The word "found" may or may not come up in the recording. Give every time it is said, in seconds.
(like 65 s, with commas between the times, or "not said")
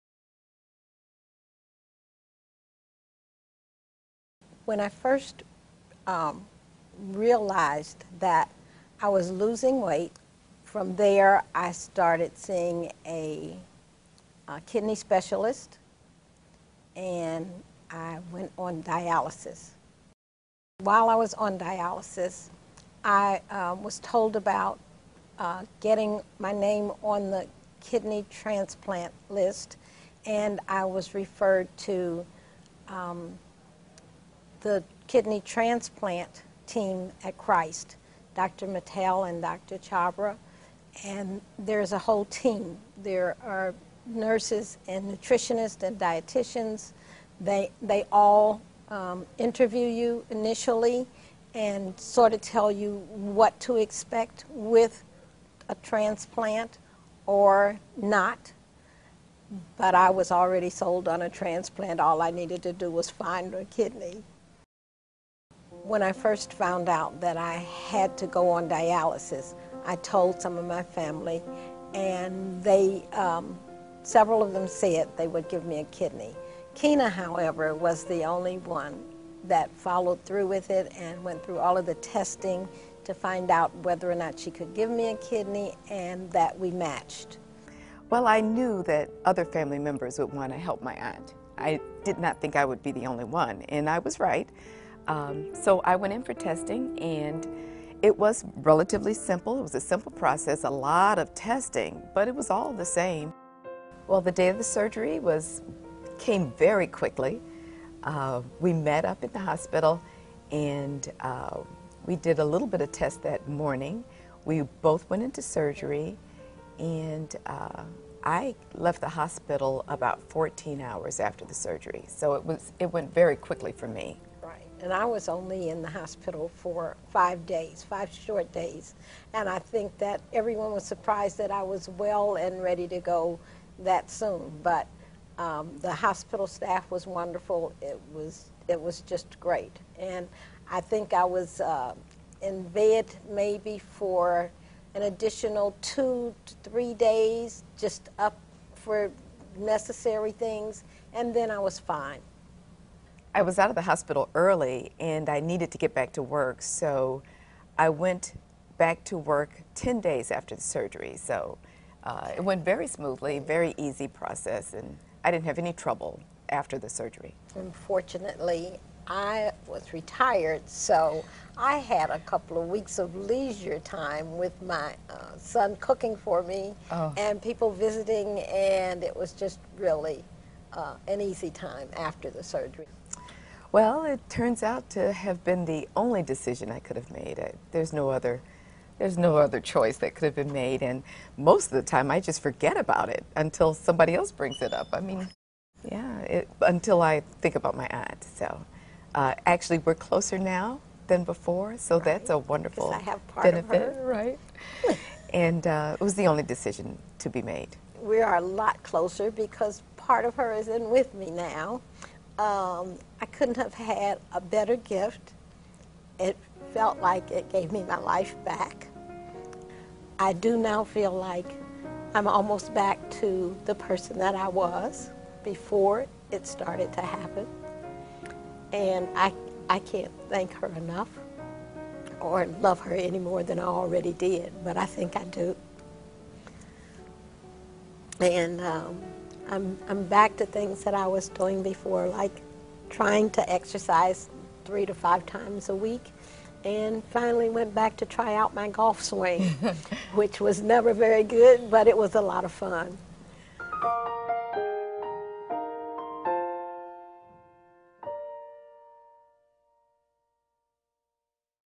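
66 s.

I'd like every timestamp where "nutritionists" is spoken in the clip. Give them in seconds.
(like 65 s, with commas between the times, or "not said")
45 s.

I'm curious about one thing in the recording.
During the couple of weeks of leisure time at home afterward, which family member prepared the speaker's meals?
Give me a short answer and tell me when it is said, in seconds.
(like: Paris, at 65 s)
Son, at 175 s.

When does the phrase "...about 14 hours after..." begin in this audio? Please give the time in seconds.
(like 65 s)
119 s.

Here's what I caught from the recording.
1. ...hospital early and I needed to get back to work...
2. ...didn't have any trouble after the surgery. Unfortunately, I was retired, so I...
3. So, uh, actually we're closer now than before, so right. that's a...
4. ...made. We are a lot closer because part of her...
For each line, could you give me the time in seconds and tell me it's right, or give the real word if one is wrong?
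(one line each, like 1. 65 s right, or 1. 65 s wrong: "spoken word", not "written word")
1. 153 s right
2. 165 s right
3. 198 s right
4. 207 s right.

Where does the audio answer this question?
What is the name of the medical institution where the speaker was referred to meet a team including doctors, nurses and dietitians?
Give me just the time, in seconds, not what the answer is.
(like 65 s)
37 s.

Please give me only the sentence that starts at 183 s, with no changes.
Well, it turns out to have been the only decision I could have made.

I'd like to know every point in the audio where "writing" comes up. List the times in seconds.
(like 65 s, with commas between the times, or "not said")
not said.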